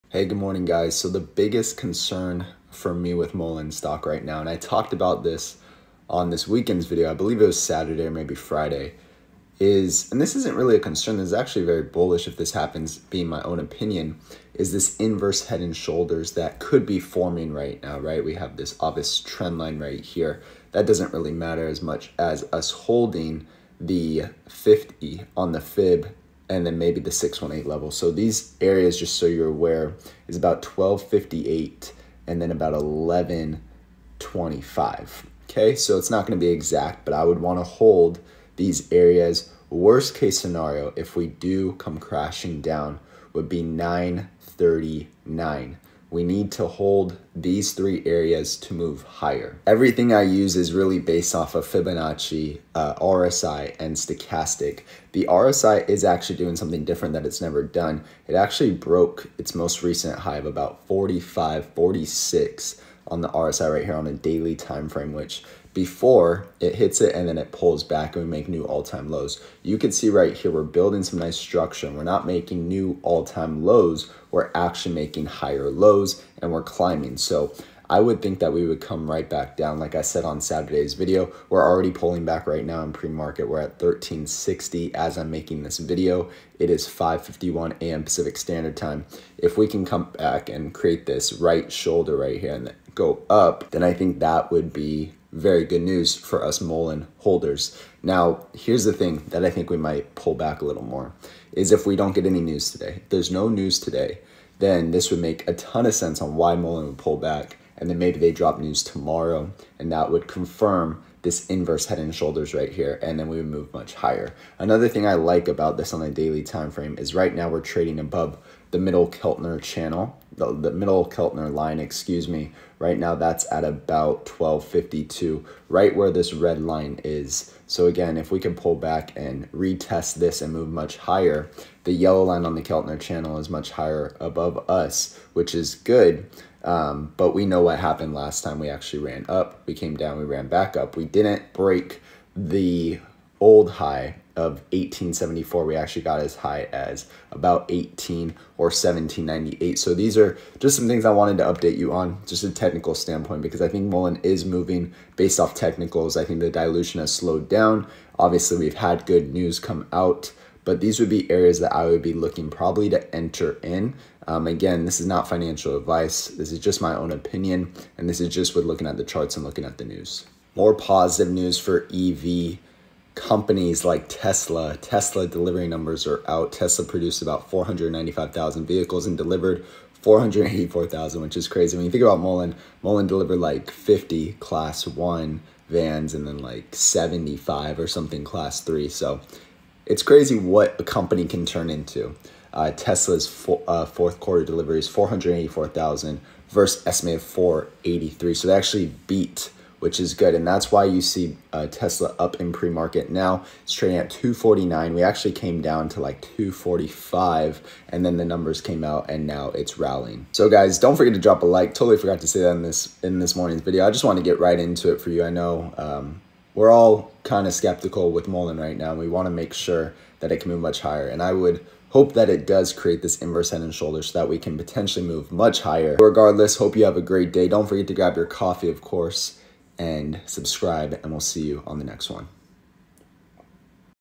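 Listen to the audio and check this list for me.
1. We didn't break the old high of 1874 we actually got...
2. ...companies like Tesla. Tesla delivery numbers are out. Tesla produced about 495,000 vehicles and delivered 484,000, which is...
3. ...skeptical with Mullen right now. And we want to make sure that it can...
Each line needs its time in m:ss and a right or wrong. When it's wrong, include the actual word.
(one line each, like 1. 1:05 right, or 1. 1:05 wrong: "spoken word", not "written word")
1. 2:20 right
2. 2:53 right
3. 3:37 right.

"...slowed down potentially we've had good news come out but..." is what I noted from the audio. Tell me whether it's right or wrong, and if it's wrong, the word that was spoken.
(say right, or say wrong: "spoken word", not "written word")
wrong: "obviously", not "potentially".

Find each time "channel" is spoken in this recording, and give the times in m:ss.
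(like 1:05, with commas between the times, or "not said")
1:59, 2:12.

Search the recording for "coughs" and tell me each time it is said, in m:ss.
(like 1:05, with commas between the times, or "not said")
not said.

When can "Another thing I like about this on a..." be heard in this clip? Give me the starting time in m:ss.
1:54.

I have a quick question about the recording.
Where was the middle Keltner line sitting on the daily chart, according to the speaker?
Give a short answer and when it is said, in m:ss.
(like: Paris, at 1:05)
12.52, at 2:04.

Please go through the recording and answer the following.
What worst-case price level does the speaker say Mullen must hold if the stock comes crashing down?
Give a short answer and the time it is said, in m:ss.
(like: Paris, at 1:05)
9.39, at 0:43.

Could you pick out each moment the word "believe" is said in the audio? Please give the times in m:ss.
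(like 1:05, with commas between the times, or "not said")
0:07.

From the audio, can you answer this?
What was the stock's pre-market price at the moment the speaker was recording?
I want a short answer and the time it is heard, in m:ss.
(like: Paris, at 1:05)
13.60, at 1:23.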